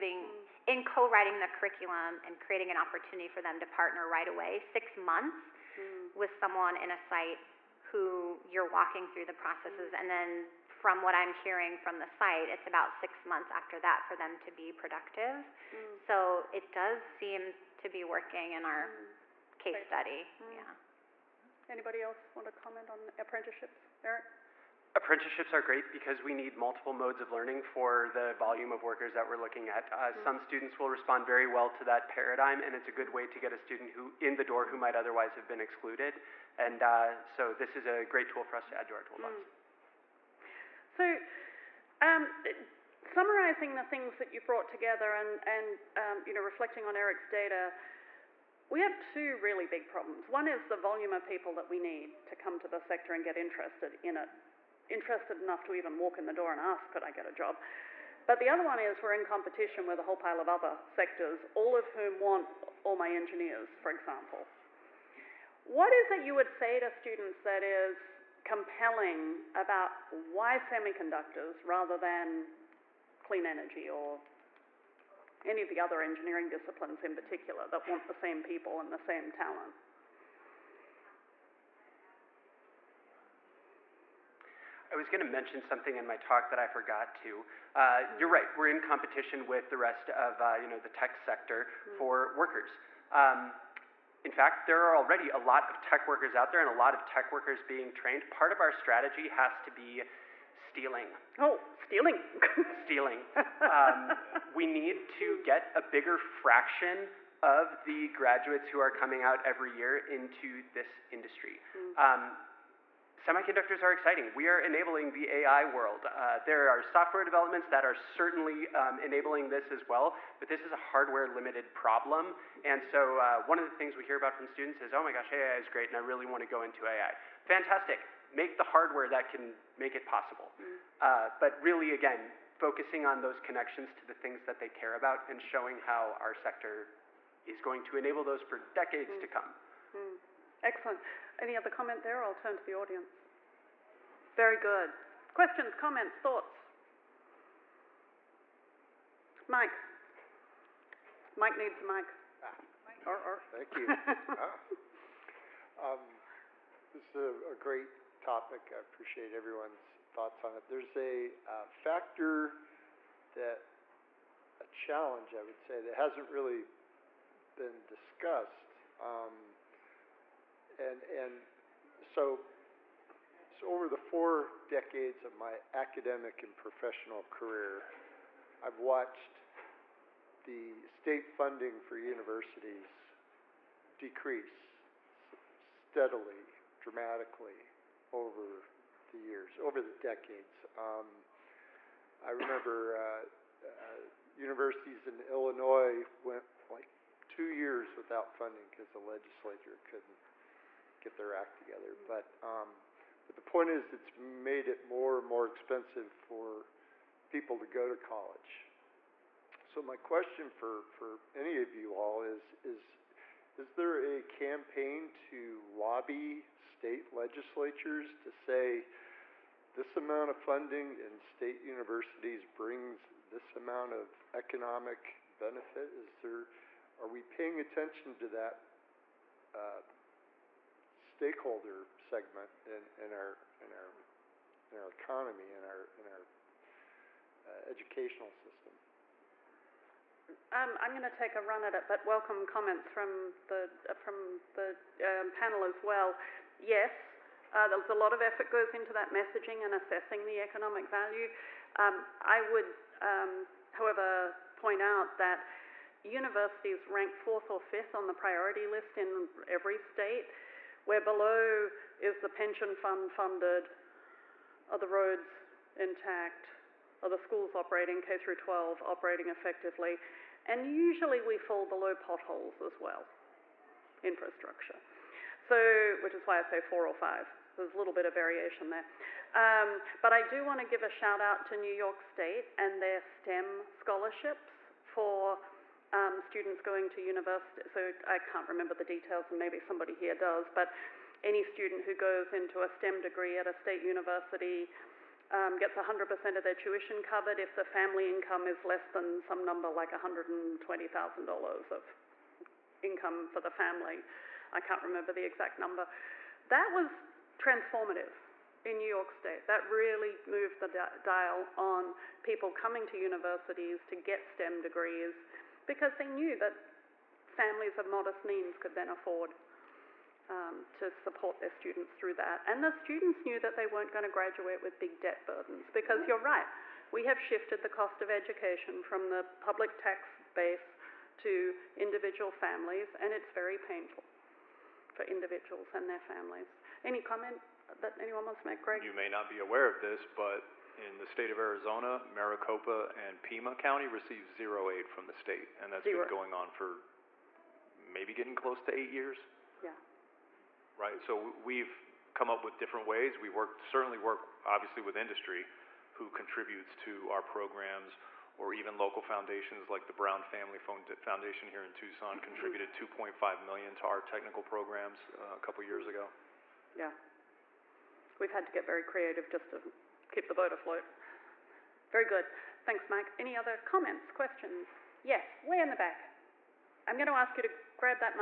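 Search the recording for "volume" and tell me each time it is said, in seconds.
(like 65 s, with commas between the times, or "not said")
28 s, 50 s.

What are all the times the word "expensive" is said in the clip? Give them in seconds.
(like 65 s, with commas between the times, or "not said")
205 s.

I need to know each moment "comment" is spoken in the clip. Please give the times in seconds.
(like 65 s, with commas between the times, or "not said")
22 s, 141 s, 145 s, 242 s, 337 s, 373 s.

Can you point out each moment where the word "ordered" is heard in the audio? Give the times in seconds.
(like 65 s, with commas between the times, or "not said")
not said.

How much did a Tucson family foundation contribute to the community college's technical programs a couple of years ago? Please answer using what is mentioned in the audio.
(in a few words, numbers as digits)
2.5 million.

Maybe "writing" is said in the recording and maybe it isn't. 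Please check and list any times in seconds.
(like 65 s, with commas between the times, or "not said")
0 s.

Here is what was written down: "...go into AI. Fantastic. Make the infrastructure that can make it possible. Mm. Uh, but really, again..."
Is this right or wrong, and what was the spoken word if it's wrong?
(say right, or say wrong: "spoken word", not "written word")
wrong: "hardware", not "infrastructure".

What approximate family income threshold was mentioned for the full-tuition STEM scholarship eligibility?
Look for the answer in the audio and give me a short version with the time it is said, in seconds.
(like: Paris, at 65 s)
$120,000, at 299 s.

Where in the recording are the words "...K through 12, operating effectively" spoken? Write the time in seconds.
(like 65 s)
268 s.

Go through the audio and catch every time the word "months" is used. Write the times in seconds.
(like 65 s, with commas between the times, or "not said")
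4 s, 13 s.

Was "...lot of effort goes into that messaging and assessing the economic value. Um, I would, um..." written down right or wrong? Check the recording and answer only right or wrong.
right.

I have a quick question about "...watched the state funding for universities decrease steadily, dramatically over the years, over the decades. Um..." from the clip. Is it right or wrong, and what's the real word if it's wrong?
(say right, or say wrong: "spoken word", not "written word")
right.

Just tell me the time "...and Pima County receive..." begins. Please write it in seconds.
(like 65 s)
342 s.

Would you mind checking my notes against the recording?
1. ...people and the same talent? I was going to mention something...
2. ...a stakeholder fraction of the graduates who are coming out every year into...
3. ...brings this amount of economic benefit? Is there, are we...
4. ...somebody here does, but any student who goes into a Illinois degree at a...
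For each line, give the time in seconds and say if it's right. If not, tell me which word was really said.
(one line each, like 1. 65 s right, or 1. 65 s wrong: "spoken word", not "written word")
1. 78 s right
2. 105 s wrong: "bigger", not "stakeholder"
3. 222 s right
4. 289 s wrong: "STEM", not "Illinois".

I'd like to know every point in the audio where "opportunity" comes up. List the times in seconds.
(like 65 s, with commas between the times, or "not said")
2 s.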